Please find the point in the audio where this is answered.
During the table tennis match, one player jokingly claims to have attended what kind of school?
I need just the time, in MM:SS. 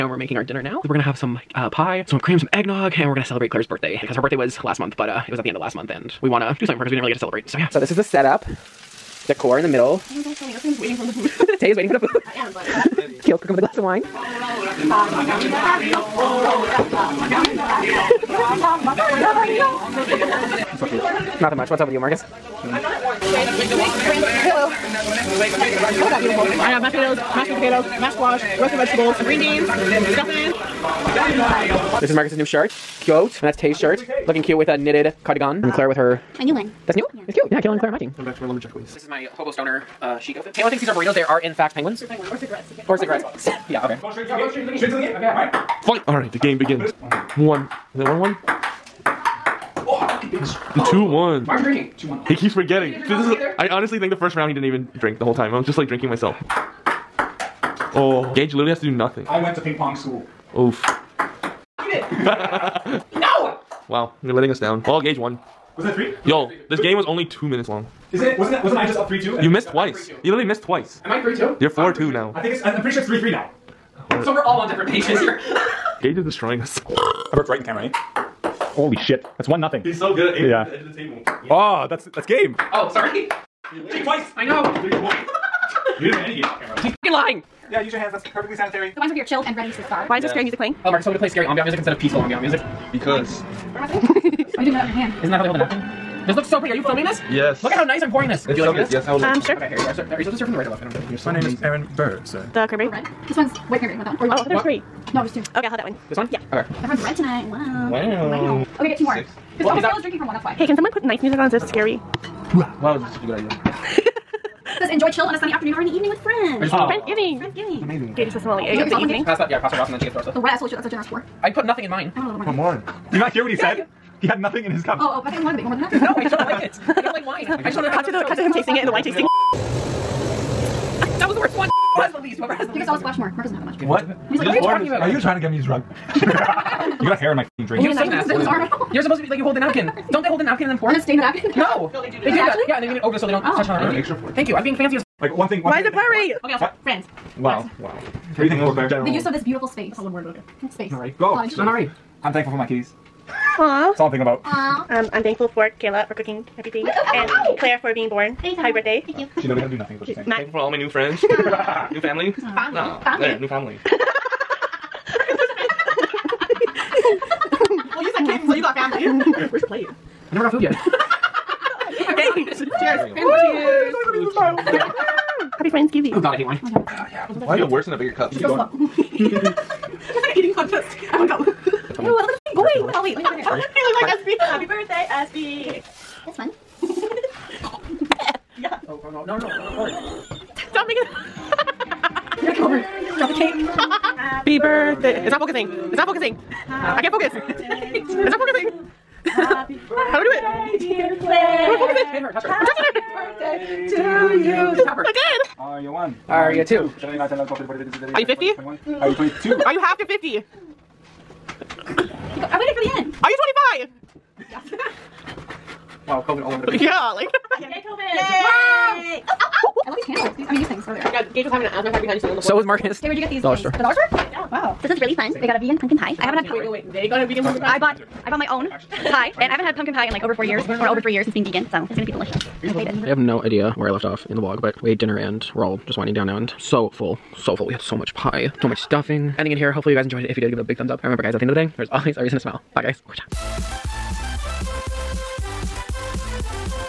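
00:59.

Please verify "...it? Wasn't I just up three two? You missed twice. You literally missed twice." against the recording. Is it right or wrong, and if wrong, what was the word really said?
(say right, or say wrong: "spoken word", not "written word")
right.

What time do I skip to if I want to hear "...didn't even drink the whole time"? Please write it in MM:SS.
00:54.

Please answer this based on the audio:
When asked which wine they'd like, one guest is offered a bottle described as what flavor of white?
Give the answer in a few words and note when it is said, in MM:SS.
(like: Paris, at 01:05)
White cranberry, at 01:43.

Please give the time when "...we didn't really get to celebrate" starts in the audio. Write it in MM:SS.
00:06.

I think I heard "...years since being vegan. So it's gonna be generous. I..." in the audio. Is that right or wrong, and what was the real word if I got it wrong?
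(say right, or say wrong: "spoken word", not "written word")
wrong: "delicious", not "generous".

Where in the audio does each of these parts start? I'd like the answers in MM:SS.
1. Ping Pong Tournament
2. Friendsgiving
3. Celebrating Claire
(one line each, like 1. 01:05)
1. 00:43
2. 01:27
3. 02:57.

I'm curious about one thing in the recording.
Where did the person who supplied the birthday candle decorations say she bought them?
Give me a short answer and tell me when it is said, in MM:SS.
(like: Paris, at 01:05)
The dollar store, at 03:43.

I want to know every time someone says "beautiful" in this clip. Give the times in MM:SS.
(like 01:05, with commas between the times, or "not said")
00:26, 02:29.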